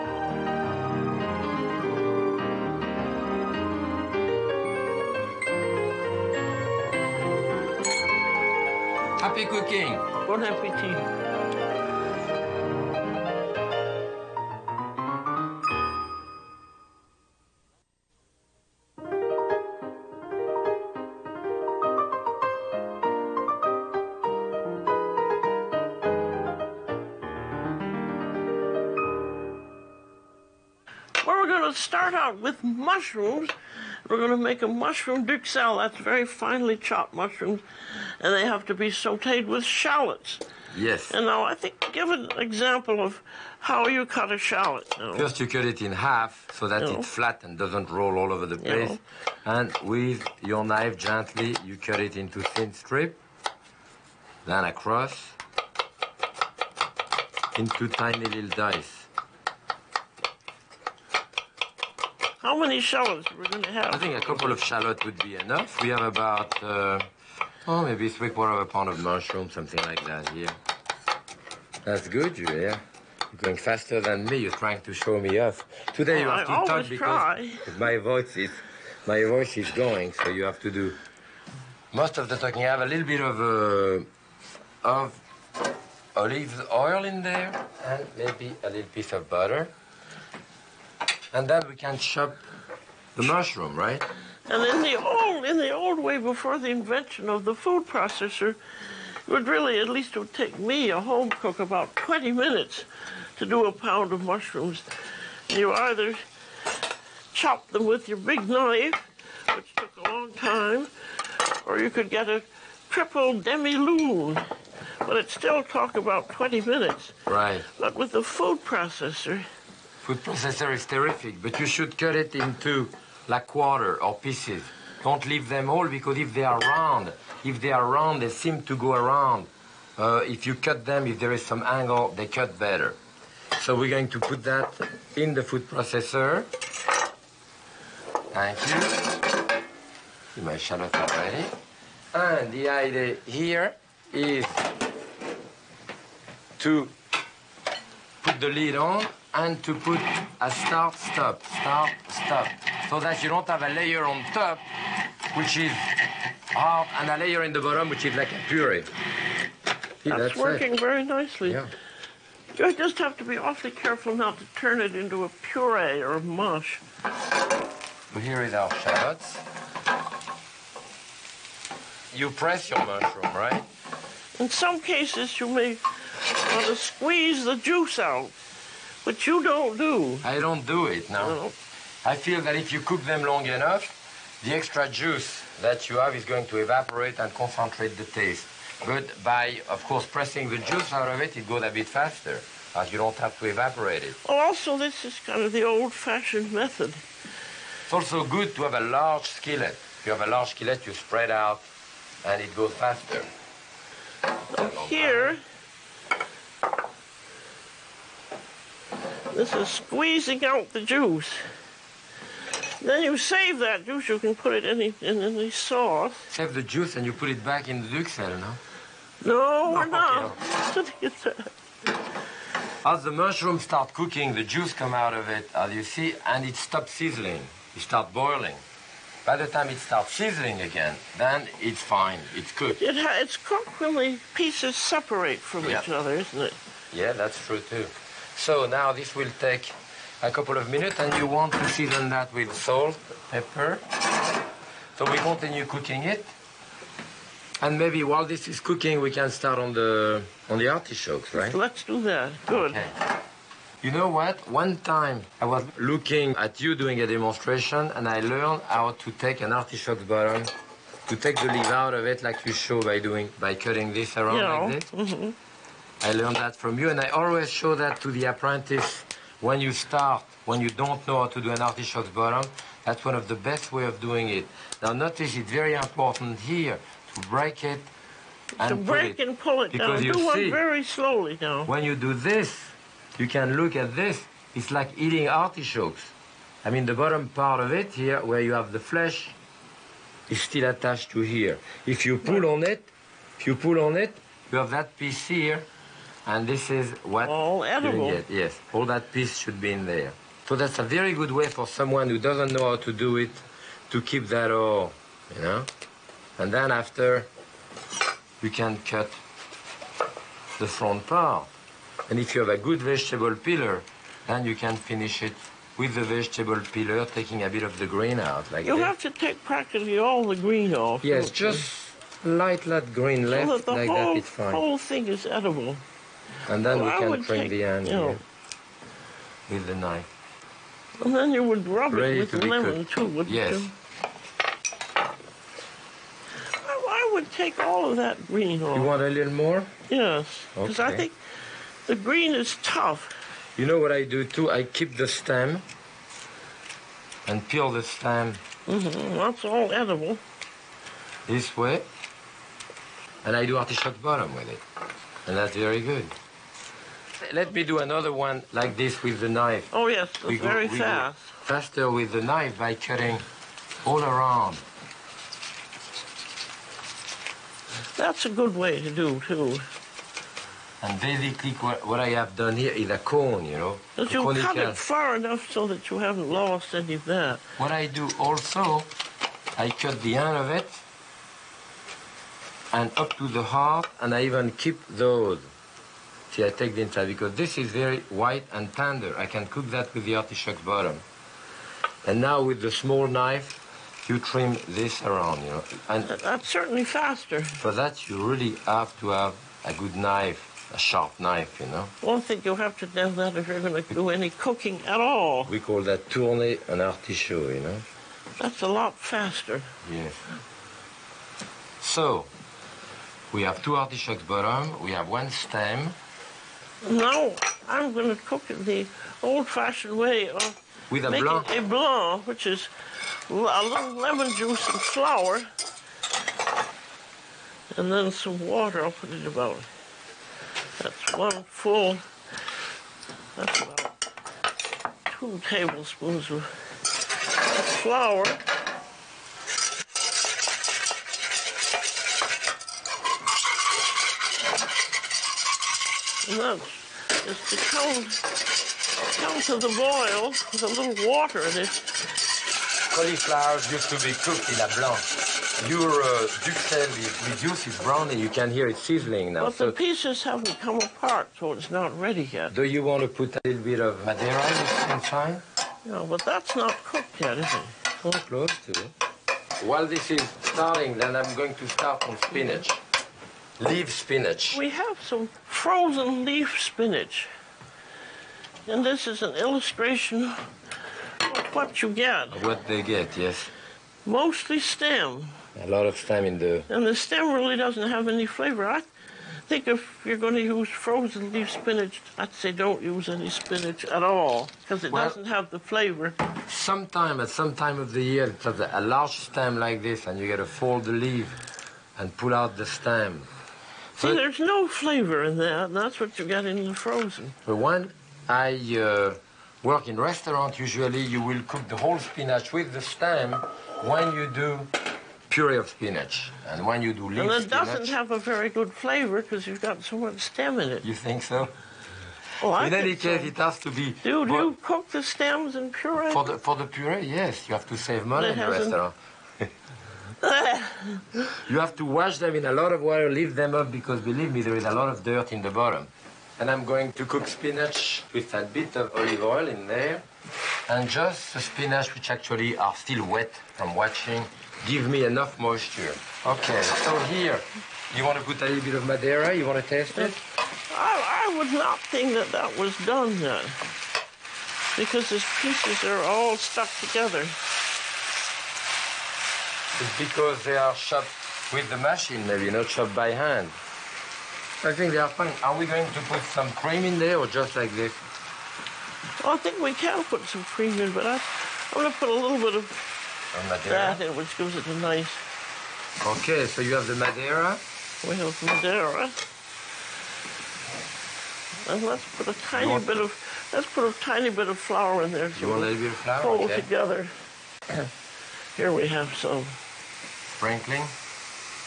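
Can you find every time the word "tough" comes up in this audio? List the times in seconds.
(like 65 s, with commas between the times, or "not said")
342 s.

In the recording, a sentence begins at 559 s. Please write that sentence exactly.
It's because they are chopped with the machine, maybe not chopped by hand.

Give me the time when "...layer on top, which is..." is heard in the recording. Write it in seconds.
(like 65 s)
153 s.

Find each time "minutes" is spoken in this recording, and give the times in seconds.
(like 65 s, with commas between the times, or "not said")
102 s, 116 s, 240 s.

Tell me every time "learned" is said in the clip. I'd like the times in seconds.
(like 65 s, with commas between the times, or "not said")
258 s, 266 s.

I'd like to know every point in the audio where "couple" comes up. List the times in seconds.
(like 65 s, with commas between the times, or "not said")
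64 s, 240 s.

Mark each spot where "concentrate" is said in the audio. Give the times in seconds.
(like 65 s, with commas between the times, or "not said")
187 s.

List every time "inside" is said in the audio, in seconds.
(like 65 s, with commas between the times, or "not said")
386 s, 464 s.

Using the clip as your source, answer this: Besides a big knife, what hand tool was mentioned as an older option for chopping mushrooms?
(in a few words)
triple demi-lune.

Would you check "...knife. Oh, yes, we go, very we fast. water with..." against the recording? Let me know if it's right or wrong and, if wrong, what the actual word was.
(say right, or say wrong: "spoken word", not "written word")
wrong: "faster", not "water".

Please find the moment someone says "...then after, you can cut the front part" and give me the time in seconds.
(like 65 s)
306 s.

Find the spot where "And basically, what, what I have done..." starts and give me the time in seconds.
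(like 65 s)
370 s.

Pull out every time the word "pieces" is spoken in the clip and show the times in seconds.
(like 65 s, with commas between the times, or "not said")
88 s, 124 s, 234 s, 294 s, 299 s, 459 s, 555 s.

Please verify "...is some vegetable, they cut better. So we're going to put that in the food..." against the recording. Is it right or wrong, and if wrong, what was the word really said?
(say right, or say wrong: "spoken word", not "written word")
wrong: "angle", not "vegetable".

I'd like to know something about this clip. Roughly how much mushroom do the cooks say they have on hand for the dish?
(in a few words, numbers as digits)
three quarters of a pound.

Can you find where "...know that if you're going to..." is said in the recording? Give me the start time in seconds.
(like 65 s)
402 s.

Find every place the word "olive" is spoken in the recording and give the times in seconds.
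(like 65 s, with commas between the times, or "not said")
86 s, 538 s.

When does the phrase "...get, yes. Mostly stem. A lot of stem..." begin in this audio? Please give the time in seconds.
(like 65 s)
482 s.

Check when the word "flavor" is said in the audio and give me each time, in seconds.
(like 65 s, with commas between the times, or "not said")
488 s, 495 s, 504 s, 518 s.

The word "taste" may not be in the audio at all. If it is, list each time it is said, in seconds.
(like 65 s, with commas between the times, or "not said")
188 s, 549 s.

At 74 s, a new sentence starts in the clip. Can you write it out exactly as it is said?
You're trying to show me off.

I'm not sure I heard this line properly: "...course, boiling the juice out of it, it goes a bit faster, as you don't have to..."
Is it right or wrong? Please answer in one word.
wrong.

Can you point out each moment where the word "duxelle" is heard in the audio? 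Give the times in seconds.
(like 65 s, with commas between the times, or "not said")
35 s, 217 s.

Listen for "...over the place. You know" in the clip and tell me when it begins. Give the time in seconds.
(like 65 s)
48 s.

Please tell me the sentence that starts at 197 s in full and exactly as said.
It's also good to have a large skillet.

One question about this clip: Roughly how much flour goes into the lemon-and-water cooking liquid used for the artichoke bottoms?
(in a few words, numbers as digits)
2 tablespoons.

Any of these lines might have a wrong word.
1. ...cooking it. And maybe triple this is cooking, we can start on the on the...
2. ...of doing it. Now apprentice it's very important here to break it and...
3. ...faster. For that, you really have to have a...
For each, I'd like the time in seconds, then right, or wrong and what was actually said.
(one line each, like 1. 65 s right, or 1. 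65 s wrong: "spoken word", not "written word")
1. 245 s wrong: "while", not "triple"
2. 273 s wrong: "notice", not "apprentice"
3. 396 s right.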